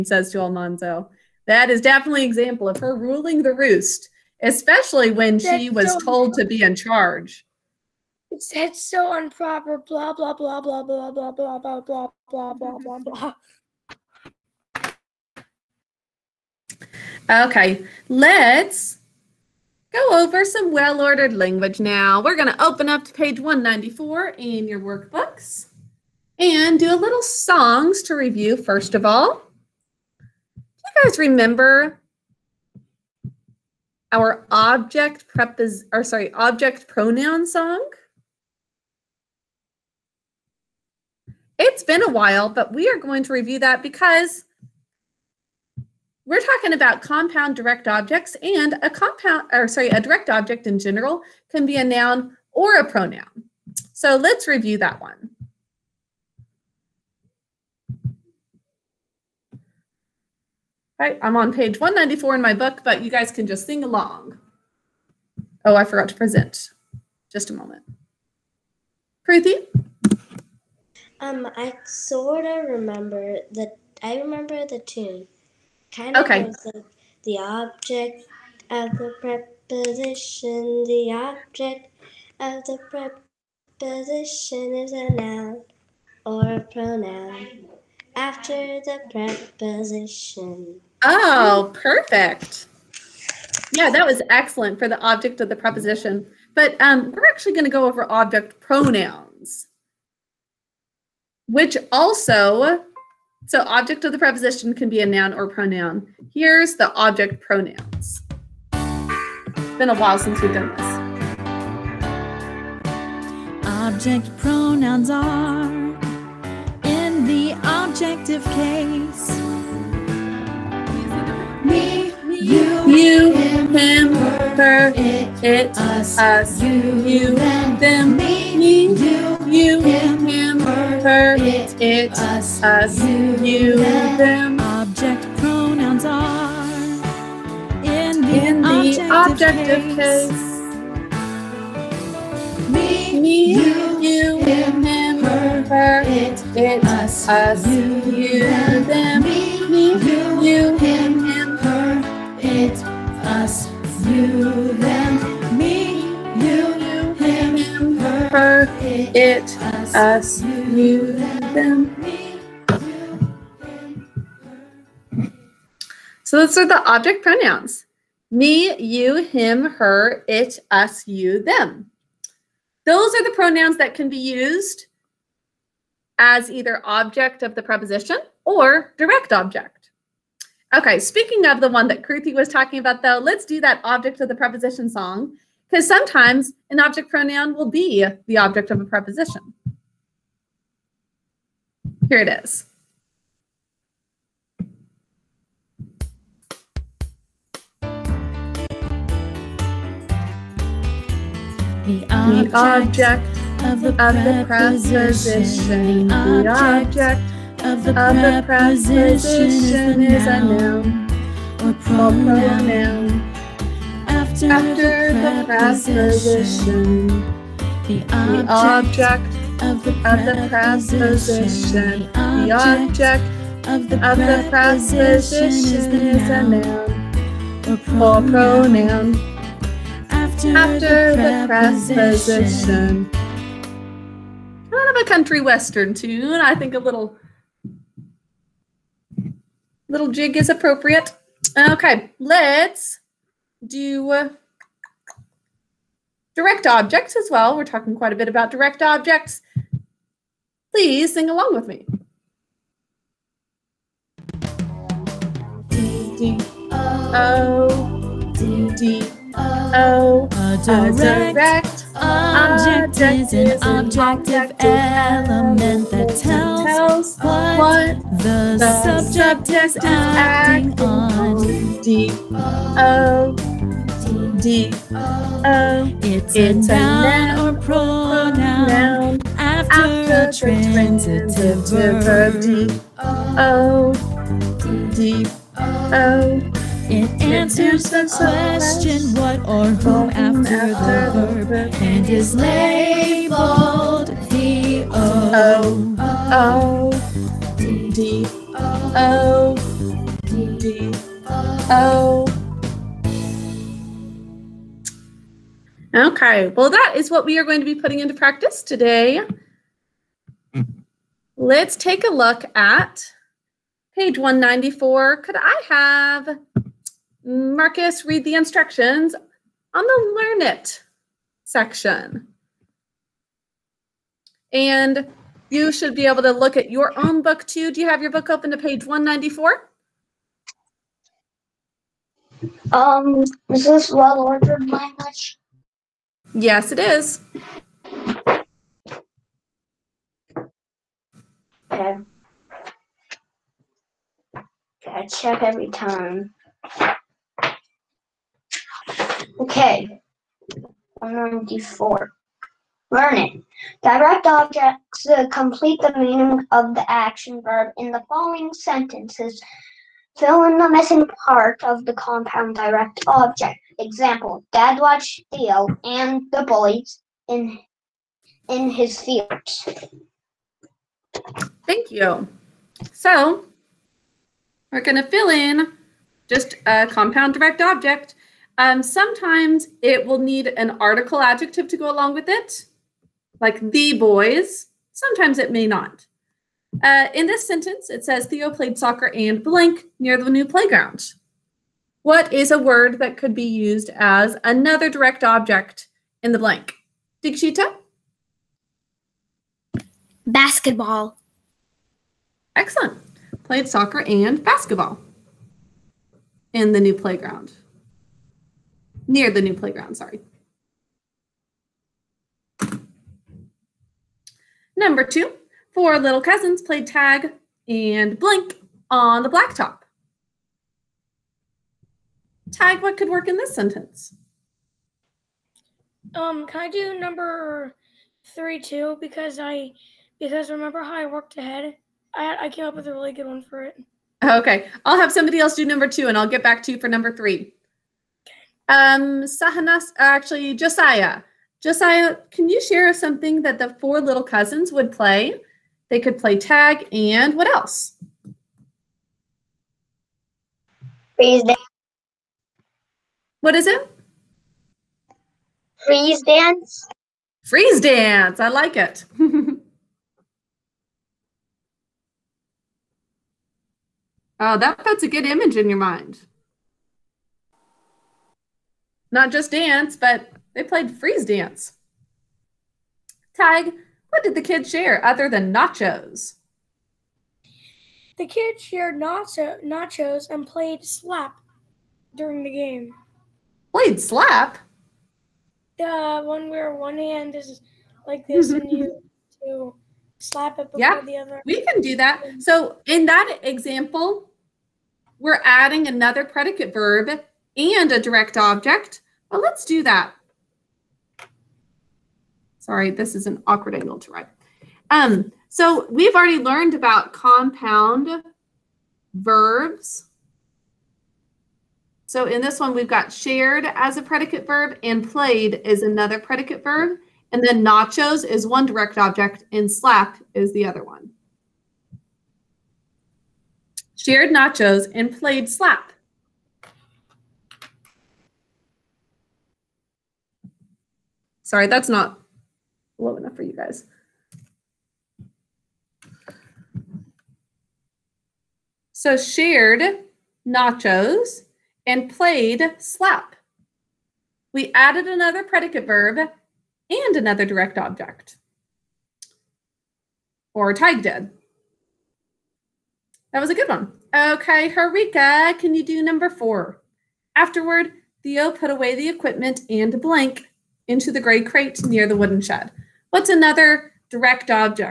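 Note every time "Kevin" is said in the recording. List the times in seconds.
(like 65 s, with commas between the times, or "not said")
not said.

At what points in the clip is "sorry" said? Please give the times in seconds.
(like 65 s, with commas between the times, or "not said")
36 s, 49 s, 409 s, 502 s, 531 s.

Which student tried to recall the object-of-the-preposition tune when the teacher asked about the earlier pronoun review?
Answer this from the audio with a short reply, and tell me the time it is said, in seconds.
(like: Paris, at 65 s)
Ruthie, at 69 s.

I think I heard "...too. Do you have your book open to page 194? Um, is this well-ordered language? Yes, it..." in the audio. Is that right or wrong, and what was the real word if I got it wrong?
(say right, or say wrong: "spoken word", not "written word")
right.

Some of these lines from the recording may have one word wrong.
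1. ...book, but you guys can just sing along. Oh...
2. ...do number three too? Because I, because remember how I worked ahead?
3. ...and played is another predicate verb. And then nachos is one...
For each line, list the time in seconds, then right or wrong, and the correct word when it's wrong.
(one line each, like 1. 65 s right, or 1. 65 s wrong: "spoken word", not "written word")
1. 62 s right
2. 426 s right
3. 514 s right.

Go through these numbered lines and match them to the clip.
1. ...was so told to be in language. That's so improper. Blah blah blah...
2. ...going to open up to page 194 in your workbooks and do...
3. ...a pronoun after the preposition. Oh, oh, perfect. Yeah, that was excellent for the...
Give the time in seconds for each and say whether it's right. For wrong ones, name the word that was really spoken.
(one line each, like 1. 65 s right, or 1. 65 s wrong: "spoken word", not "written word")
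1. 5 s wrong: "charge", not "language"
2. 22 s right
3. 86 s right.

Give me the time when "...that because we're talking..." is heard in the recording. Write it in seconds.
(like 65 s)
43 s.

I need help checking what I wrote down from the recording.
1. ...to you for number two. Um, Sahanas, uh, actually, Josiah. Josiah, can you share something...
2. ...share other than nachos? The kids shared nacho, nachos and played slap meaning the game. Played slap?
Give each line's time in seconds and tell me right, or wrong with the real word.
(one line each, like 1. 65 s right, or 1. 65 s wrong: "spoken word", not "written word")
1. 436 s wrong: "three", not "two"
2. 474 s wrong: "during", not "meaning".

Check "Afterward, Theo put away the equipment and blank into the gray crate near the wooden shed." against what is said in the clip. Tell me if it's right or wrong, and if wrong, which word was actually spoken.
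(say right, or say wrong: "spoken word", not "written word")
right.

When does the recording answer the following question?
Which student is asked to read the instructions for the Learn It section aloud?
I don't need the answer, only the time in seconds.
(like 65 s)
317 s.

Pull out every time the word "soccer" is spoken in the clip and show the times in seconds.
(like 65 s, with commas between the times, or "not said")
388 s, 403 s.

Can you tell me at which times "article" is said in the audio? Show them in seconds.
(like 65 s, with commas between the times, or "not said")
380 s.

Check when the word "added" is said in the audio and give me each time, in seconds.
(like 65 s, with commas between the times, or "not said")
544 s.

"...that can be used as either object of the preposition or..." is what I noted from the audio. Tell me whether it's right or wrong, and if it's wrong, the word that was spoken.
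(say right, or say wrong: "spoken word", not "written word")
right.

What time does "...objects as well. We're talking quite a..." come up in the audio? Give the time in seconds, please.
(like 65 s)
246 s.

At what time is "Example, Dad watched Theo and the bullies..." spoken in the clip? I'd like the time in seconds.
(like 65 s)
363 s.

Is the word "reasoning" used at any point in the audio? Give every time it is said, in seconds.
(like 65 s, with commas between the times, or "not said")
not said.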